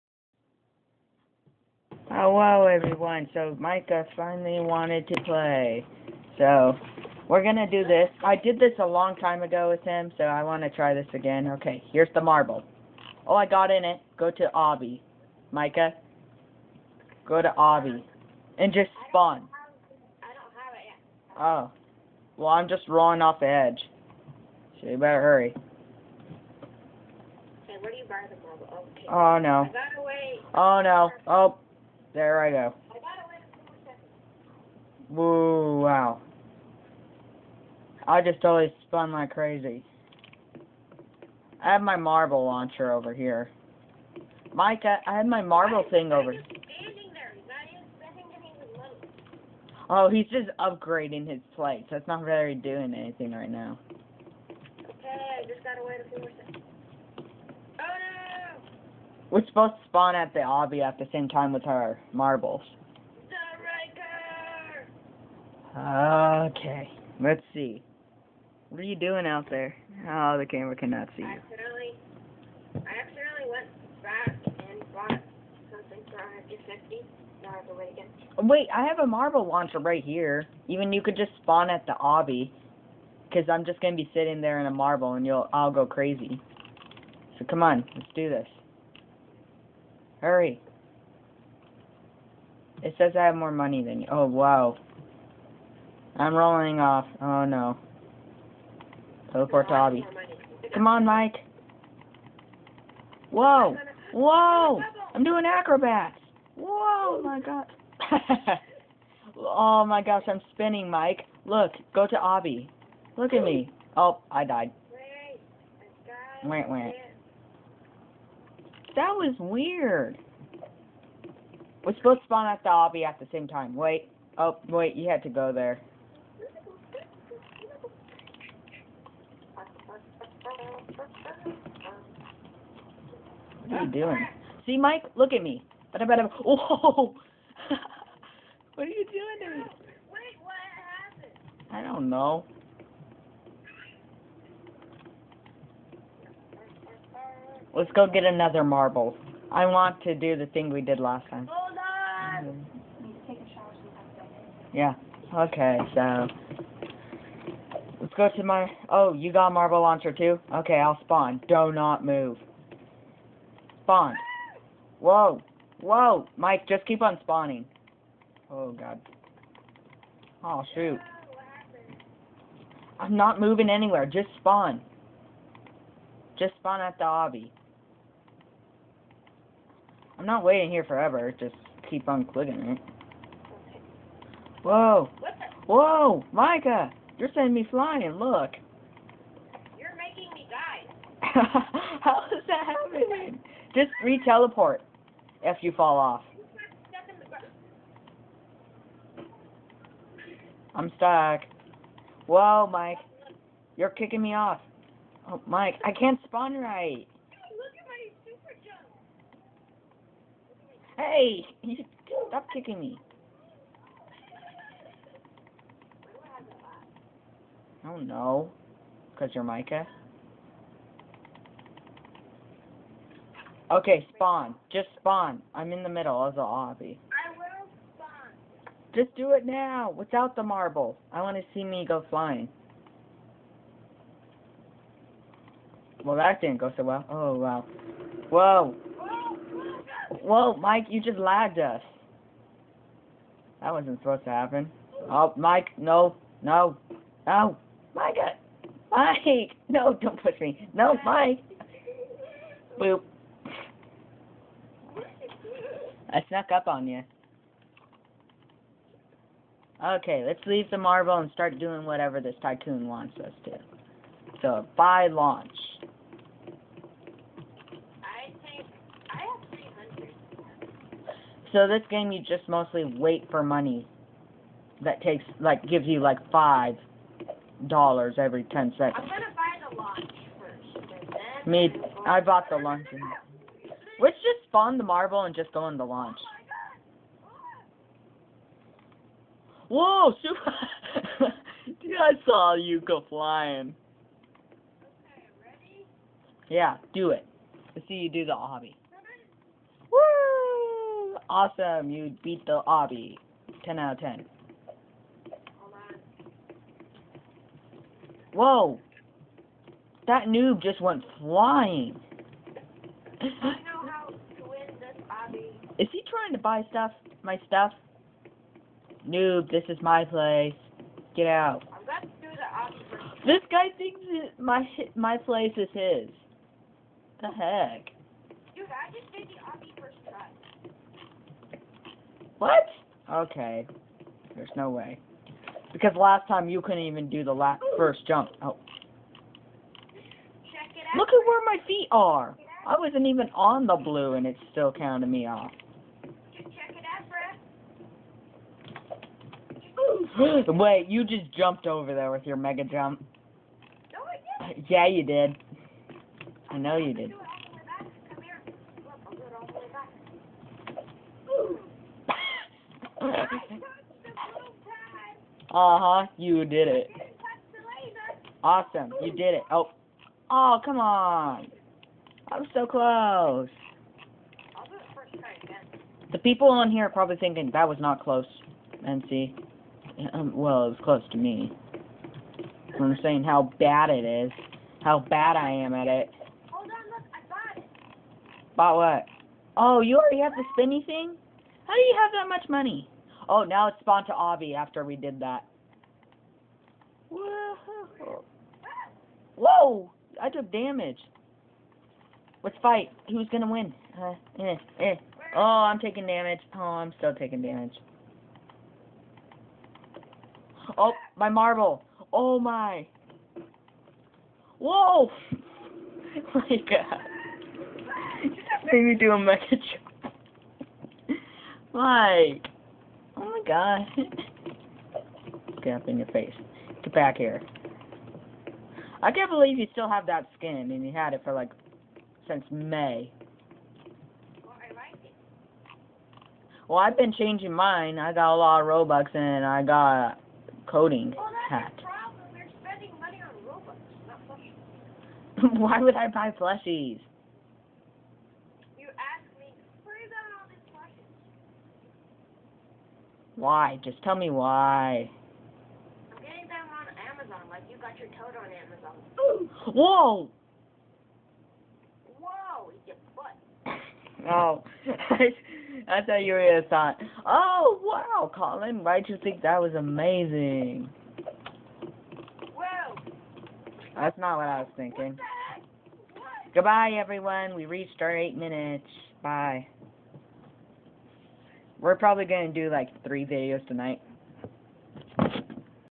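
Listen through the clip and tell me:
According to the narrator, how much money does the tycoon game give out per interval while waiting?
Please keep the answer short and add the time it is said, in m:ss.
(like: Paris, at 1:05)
$5 every 10 seconds, at 4:36.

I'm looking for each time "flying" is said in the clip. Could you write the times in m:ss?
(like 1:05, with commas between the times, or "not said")
3:07, 3:52, 4:53, 5:11.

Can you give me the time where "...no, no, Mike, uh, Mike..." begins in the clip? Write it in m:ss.
4:06.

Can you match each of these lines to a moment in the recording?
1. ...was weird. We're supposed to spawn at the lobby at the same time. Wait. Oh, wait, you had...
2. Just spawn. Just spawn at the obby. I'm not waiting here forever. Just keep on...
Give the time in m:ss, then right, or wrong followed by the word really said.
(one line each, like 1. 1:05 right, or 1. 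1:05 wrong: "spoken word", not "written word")
1. 1:59 right
2. 2:54 right.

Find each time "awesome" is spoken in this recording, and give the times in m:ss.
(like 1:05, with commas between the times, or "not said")
5:01, 6:08.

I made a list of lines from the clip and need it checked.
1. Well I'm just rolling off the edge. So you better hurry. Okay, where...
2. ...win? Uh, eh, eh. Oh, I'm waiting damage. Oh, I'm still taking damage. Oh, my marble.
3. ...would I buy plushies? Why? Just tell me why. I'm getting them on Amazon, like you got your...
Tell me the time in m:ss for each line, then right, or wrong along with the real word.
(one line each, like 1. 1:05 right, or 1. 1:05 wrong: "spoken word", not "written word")
1. 0:22 right
2. 6:43 wrong: "taking", not "waiting"
3. 7:25 right.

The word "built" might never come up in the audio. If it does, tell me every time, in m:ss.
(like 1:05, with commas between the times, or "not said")
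not said.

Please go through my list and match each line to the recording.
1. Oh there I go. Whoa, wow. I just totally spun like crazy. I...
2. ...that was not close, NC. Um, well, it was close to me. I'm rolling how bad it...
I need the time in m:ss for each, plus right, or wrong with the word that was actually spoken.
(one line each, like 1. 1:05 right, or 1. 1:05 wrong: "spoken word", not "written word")
1. 0:31 right
2. 6:17 wrong: "saying", not "rolling".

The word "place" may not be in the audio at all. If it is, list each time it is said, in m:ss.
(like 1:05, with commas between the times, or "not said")
5:20, 5:25.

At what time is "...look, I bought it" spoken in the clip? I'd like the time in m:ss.
6:26.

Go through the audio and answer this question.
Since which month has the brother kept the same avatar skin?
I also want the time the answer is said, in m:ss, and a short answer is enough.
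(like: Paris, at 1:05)
May, at 7:12.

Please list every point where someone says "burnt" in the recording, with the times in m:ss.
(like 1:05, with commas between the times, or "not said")
not said.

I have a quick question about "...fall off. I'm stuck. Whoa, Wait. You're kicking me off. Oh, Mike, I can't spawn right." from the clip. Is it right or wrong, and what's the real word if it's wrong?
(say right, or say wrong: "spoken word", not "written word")
wrong: "Mike", not "Wait".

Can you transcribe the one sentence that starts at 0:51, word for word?
That's not very doing anything right now.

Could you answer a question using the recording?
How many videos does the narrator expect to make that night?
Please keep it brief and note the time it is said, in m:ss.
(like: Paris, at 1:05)
3, at 8:03.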